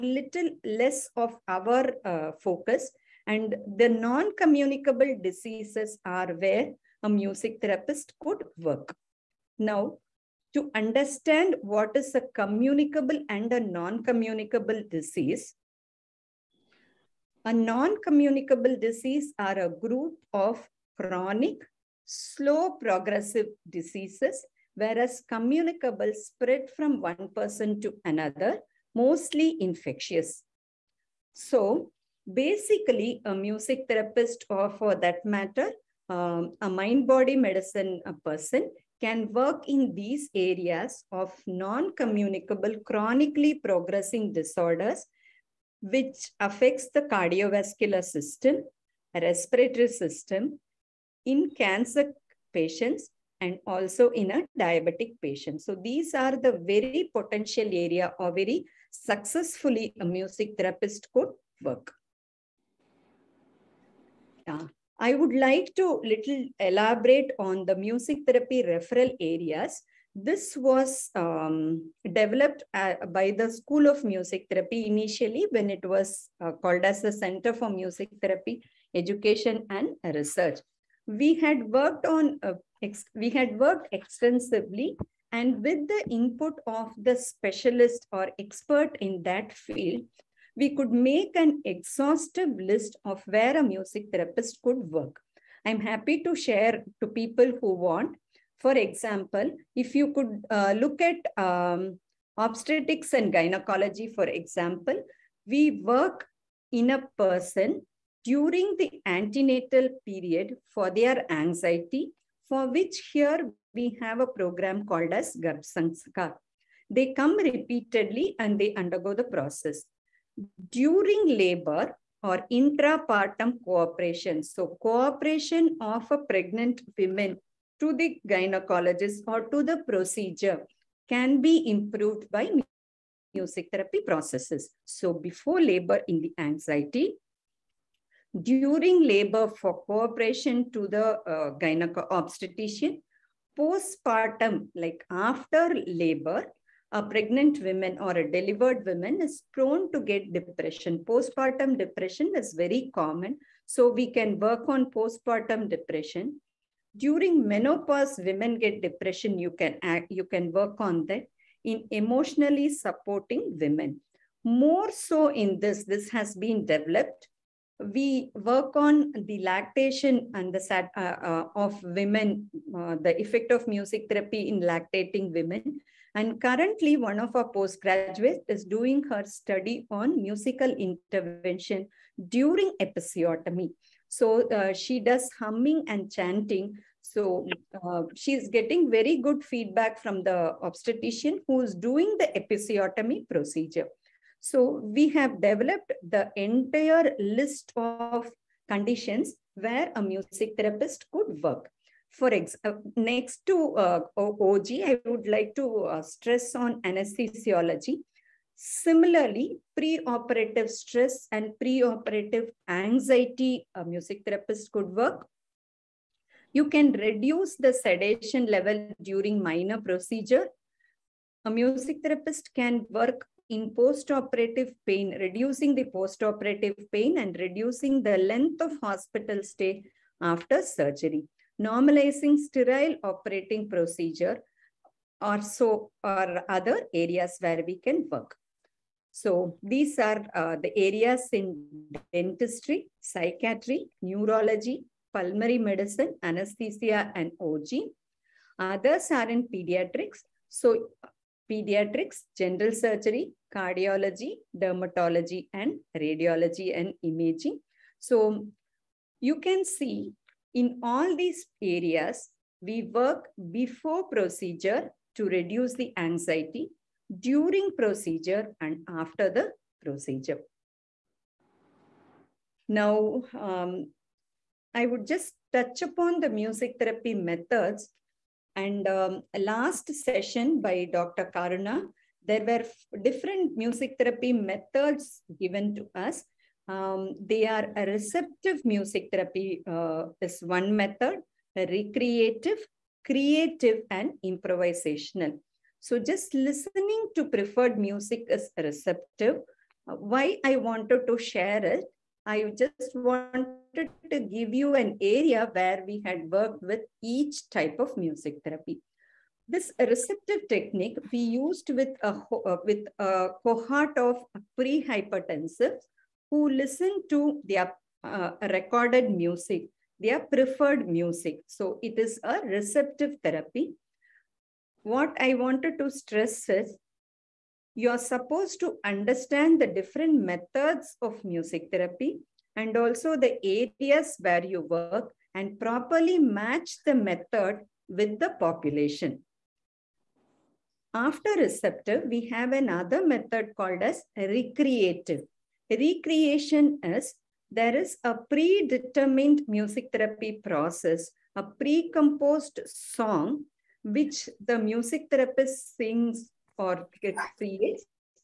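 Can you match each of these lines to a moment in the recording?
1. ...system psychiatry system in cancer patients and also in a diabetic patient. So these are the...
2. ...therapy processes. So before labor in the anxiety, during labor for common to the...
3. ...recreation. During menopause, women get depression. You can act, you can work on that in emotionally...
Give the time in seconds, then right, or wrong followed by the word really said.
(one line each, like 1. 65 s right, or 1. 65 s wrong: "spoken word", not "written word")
1. 48 s wrong: "respiratory", not "psychiatry"
2. 133 s wrong: "cooperation", not "common"
3. 155 s wrong: "depression", not "recreation".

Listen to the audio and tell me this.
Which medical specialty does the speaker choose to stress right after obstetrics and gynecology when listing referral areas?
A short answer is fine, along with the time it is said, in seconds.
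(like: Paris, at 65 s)
Anesthesiology, at 206 s.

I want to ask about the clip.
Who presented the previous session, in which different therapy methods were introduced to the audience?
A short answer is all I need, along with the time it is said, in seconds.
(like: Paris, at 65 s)
Dr. Karuna, at 280 s.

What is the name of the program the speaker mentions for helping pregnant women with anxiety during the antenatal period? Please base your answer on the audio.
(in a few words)
Garbh Sanskar.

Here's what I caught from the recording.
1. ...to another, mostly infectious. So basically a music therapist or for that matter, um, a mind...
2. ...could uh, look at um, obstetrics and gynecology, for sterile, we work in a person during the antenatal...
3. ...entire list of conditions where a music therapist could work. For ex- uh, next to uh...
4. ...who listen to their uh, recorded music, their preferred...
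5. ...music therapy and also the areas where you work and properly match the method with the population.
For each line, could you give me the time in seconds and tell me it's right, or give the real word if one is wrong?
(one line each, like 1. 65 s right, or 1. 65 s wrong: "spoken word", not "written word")
1. 27 s right
2. 100 s wrong: "example", not "sterile"
3. 196 s right
4. 316 s right
5. 331 s right.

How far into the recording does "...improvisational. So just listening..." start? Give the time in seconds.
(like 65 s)
294 s.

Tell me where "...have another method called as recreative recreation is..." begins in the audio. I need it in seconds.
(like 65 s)
342 s.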